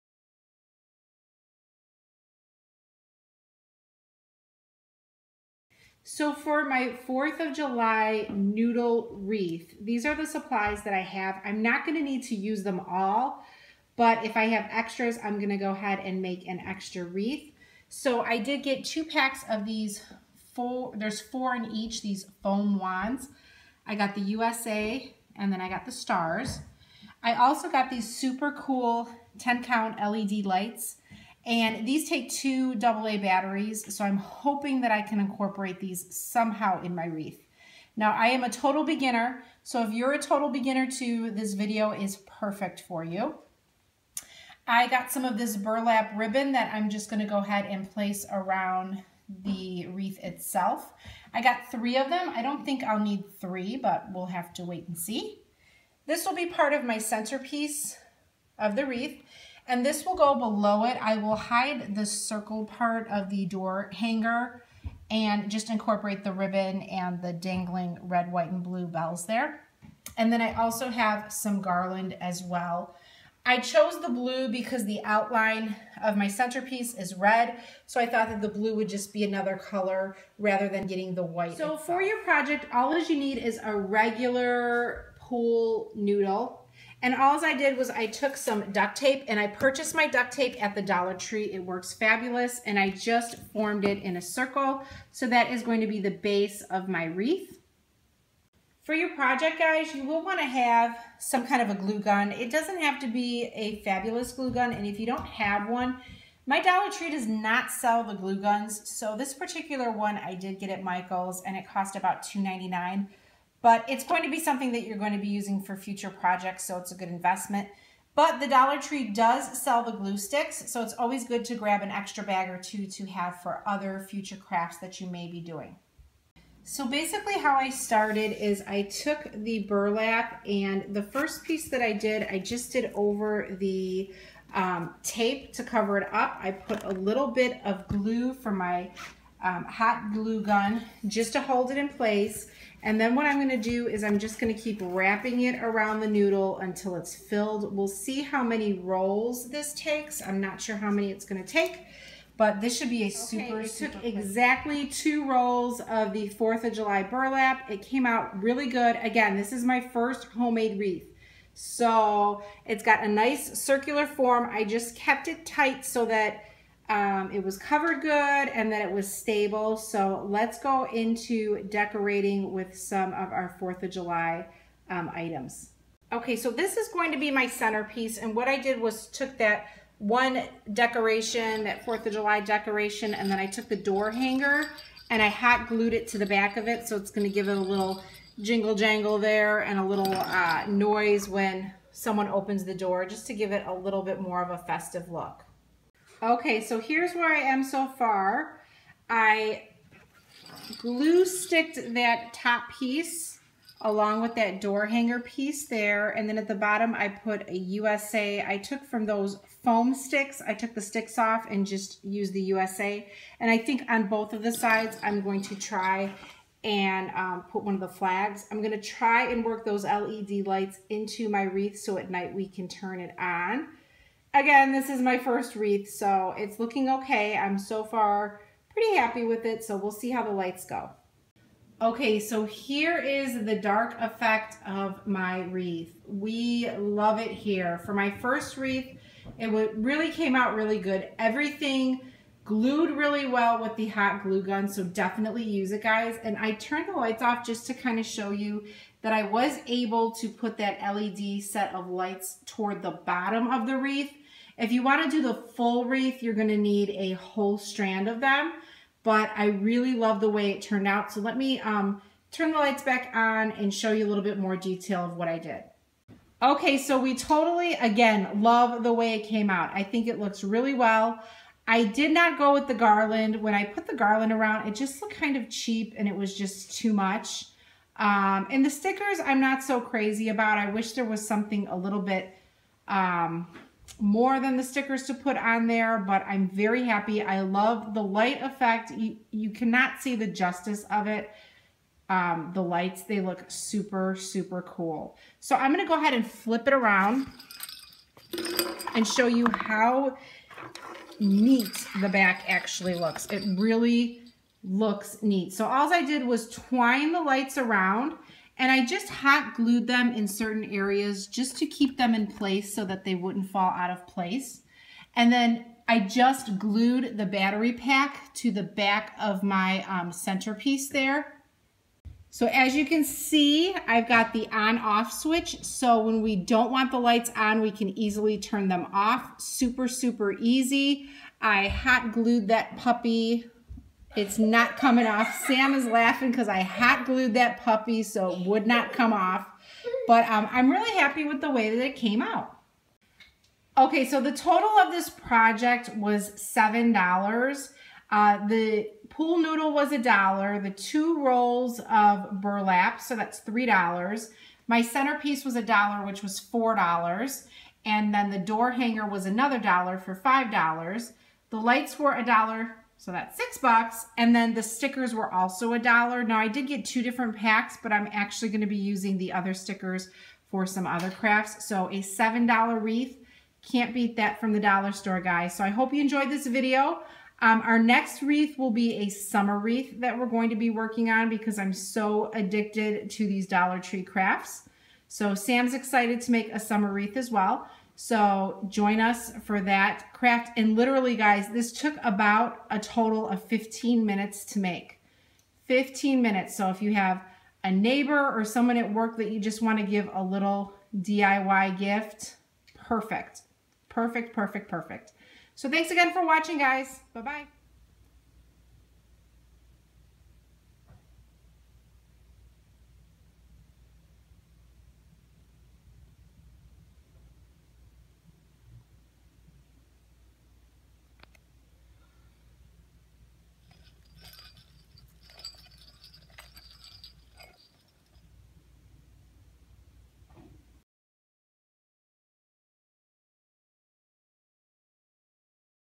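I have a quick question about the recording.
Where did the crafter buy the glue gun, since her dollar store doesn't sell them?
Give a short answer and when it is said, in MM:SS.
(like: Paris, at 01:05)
Michael's, at 01:50.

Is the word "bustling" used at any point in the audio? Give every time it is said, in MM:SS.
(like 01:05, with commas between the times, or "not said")
not said.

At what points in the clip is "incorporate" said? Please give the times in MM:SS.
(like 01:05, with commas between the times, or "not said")
00:35, 01:05.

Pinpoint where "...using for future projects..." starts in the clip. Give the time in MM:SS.
01:55.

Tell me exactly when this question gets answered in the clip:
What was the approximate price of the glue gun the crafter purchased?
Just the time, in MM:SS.
01:52.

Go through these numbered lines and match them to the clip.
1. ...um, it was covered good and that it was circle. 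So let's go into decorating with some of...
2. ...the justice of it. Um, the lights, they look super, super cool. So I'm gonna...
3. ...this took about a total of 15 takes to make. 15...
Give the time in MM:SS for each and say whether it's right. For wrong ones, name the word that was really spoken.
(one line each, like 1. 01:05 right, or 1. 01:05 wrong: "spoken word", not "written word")
1. 02:46 wrong: "stable", not "circle"
2. 04:50 right
3. 06:31 wrong: "minutes", not "takes".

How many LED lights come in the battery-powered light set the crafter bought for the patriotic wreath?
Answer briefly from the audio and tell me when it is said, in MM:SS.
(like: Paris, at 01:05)
10, at 00:29.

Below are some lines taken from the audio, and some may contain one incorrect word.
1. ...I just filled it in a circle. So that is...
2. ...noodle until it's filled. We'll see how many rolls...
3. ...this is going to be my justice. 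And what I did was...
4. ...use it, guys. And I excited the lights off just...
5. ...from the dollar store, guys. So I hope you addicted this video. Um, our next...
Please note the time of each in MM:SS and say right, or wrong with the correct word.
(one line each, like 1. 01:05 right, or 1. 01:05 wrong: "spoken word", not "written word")
1. 01:32 wrong: "formed", not "filled"
2. 02:26 right
3. 02:56 wrong: "centerpiece", not "justice"
4. 04:05 wrong: "turned", not "excited"
5. 06:14 wrong: "enjoyed", not "addicted".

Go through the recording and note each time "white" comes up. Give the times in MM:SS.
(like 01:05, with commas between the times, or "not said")
01:08, 01:21.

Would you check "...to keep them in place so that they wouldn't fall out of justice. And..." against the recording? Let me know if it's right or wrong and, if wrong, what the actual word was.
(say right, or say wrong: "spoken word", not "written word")
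wrong: "place", not "justice".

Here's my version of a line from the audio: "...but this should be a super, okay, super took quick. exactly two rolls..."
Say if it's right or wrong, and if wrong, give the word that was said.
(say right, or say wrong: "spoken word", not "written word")
right.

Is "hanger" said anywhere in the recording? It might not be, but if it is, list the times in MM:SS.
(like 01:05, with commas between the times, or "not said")
01:03, 03:04, 03:24, 05:58.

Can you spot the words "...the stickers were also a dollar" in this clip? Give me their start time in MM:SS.
06:04.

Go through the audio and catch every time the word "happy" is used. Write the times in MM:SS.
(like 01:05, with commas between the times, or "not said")
03:48, 04:46, 05:40.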